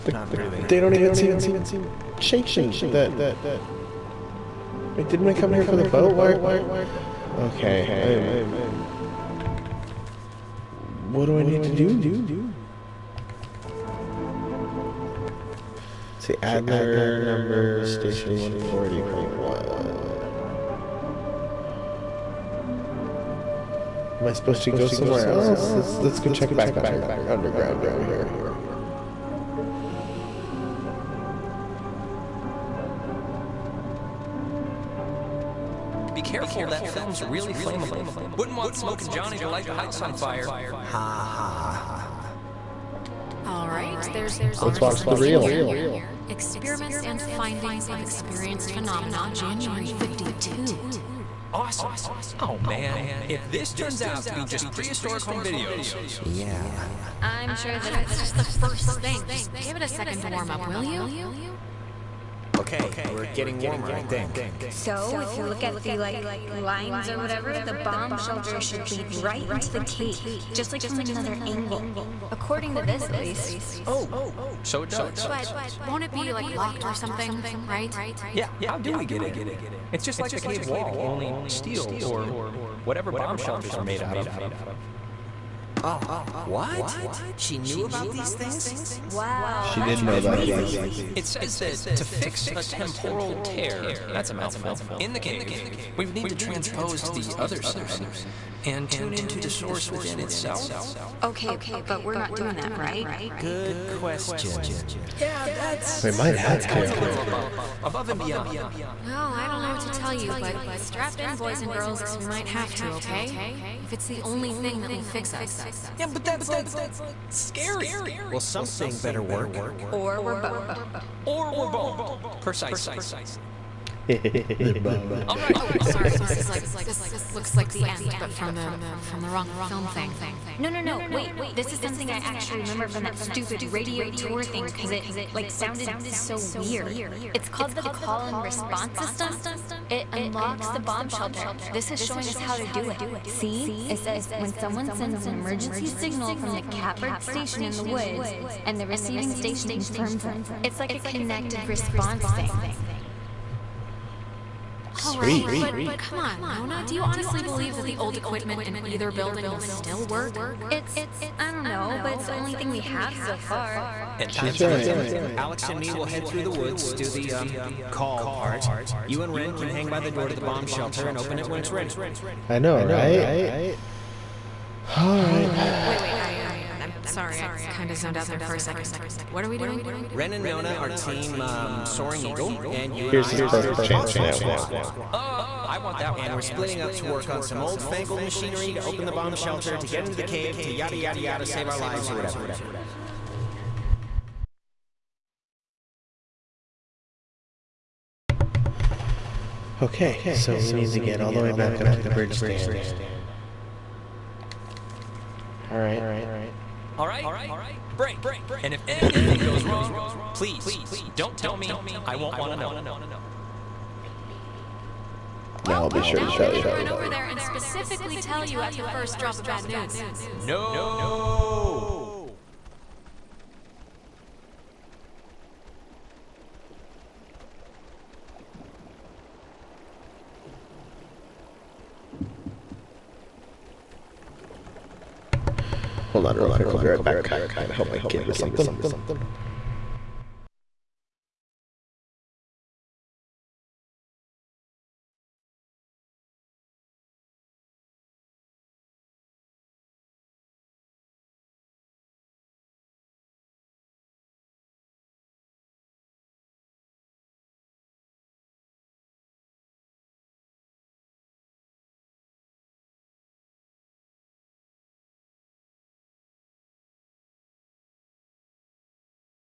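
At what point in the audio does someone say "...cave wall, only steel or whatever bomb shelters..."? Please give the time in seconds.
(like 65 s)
80 s.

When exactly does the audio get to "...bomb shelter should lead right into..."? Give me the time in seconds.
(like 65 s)
67 s.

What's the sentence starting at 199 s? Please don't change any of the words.
Okay, so we need to get all the way back up to the bridge stand.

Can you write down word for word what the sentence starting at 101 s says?
Okay, but we're not doing that, right?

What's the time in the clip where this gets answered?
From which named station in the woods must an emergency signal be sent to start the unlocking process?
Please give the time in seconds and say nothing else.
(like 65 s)
146 s.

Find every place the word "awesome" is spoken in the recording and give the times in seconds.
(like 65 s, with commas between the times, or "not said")
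51 s, 184 s.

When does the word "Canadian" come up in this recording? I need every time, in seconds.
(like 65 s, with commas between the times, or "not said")
not said.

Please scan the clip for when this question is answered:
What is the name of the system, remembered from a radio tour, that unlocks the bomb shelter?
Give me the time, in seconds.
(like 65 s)
137 s.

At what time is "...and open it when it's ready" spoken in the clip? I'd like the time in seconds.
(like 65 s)
171 s.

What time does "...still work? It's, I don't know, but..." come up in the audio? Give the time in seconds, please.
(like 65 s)
159 s.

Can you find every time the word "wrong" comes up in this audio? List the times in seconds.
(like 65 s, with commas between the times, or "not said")
129 s, 209 s.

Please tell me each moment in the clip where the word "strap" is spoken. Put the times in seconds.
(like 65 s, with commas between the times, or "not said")
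110 s.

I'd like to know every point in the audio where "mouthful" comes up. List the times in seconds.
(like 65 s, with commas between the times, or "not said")
94 s.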